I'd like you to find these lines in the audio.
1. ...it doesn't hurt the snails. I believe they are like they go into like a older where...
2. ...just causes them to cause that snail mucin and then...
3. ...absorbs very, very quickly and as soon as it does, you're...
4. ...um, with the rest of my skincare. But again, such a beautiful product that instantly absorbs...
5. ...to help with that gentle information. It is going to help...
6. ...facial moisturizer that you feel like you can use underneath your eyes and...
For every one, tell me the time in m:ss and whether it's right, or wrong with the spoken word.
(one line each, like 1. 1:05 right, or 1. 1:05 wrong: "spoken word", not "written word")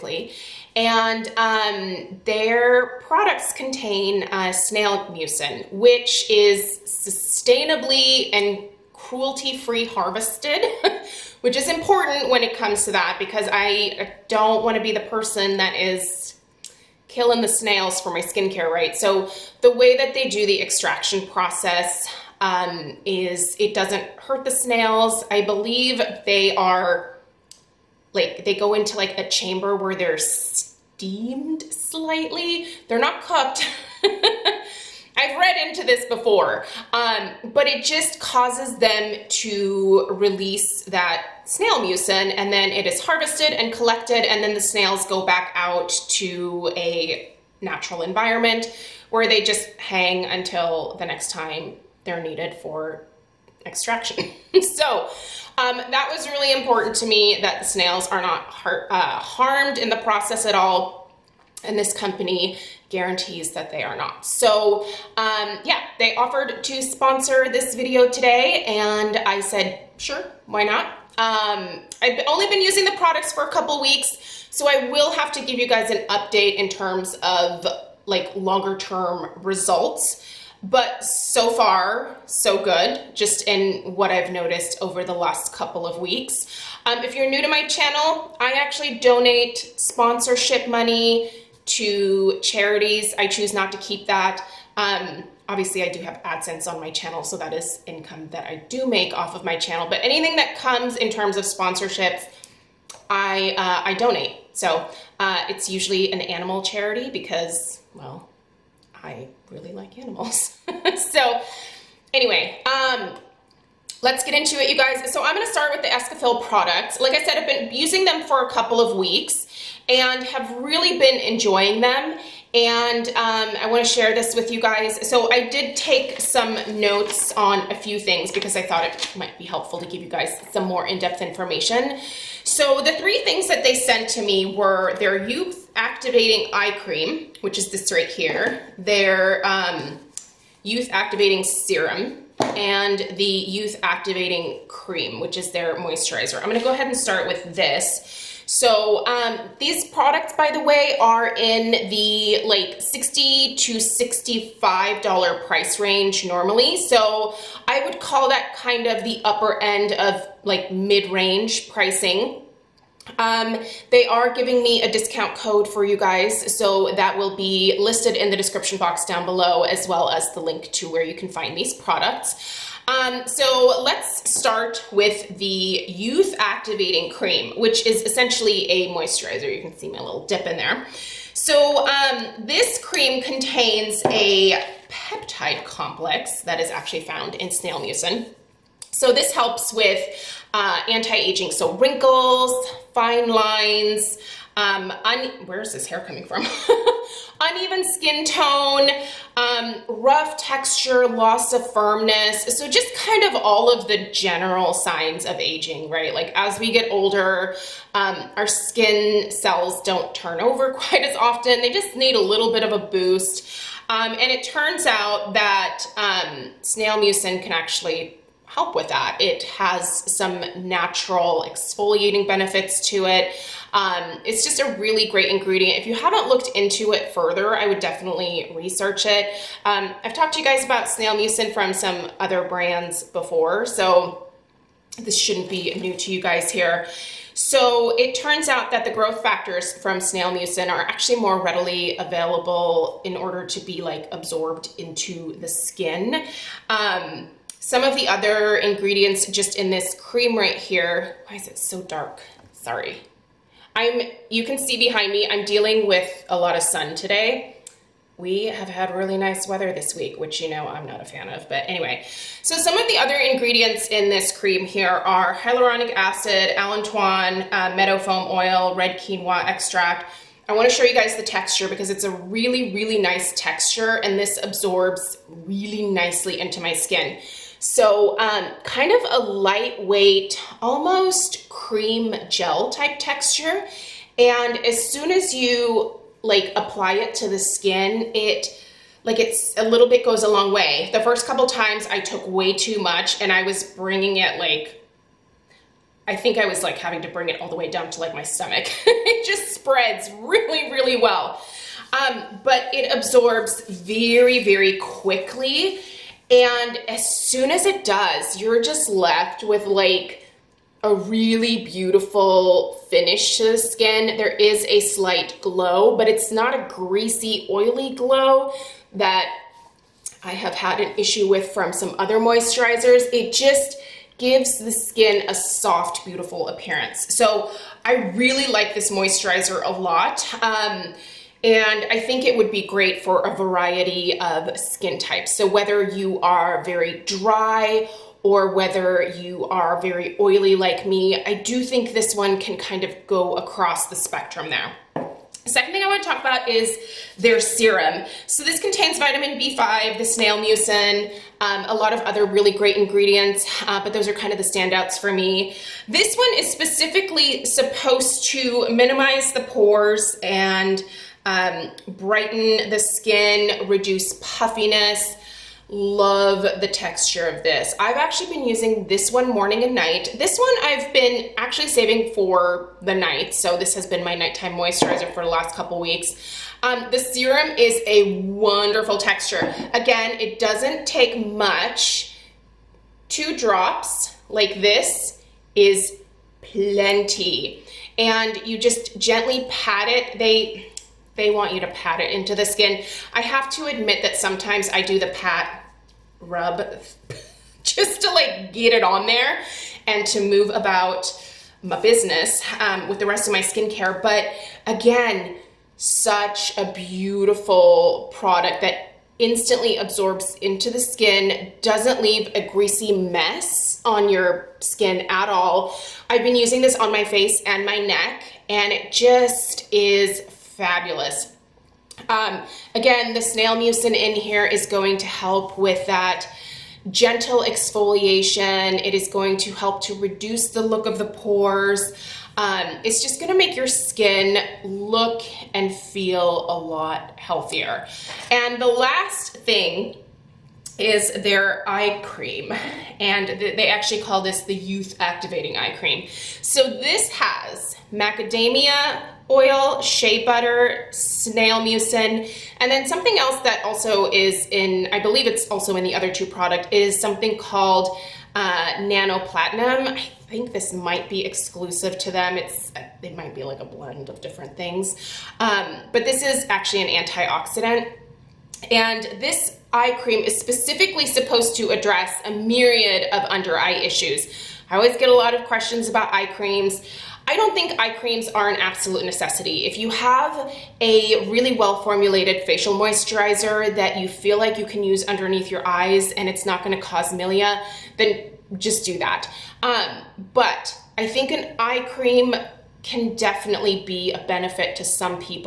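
1. 0:23 wrong: "chamber", not "older"
2. 0:37 wrong: "release", not "cause"
3. 5:02 right
4. 6:42 right
5. 7:04 wrong: "exfoliation", not "information"
6. 8:02 right.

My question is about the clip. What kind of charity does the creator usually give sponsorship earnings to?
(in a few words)
Animal charity.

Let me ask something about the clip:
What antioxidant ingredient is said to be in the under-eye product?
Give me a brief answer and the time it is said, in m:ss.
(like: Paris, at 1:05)
Nano Platinum, at 7:38.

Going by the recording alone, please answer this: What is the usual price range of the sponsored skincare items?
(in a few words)
$60 to $65.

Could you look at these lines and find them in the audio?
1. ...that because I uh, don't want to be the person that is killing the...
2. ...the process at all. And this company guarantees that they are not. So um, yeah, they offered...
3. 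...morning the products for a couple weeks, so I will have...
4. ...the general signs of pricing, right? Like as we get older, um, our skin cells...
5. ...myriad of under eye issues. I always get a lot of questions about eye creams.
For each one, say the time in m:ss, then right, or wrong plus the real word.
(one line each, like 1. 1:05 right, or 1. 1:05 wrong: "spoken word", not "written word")
1. 0:12 right
2. 0:59 right
3. 1:12 wrong: "using", not "morning"
4. 3:23 wrong: "aging", not "pricing"
5. 7:52 right.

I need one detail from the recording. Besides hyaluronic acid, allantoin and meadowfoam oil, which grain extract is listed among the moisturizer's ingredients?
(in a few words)
Red quinoa extract.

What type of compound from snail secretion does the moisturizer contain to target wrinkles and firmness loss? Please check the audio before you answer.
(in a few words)
Peptide complex.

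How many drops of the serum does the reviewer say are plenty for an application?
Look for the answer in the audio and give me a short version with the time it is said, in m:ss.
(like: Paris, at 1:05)
2, at 6:23.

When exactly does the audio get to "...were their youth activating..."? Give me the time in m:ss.
2:14.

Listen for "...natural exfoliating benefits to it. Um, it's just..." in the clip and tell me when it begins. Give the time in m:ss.
3:40.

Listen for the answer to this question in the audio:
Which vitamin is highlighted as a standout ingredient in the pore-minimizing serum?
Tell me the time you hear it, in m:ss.
5:48.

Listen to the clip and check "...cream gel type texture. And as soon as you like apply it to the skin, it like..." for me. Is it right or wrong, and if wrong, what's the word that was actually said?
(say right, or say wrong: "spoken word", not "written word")
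right.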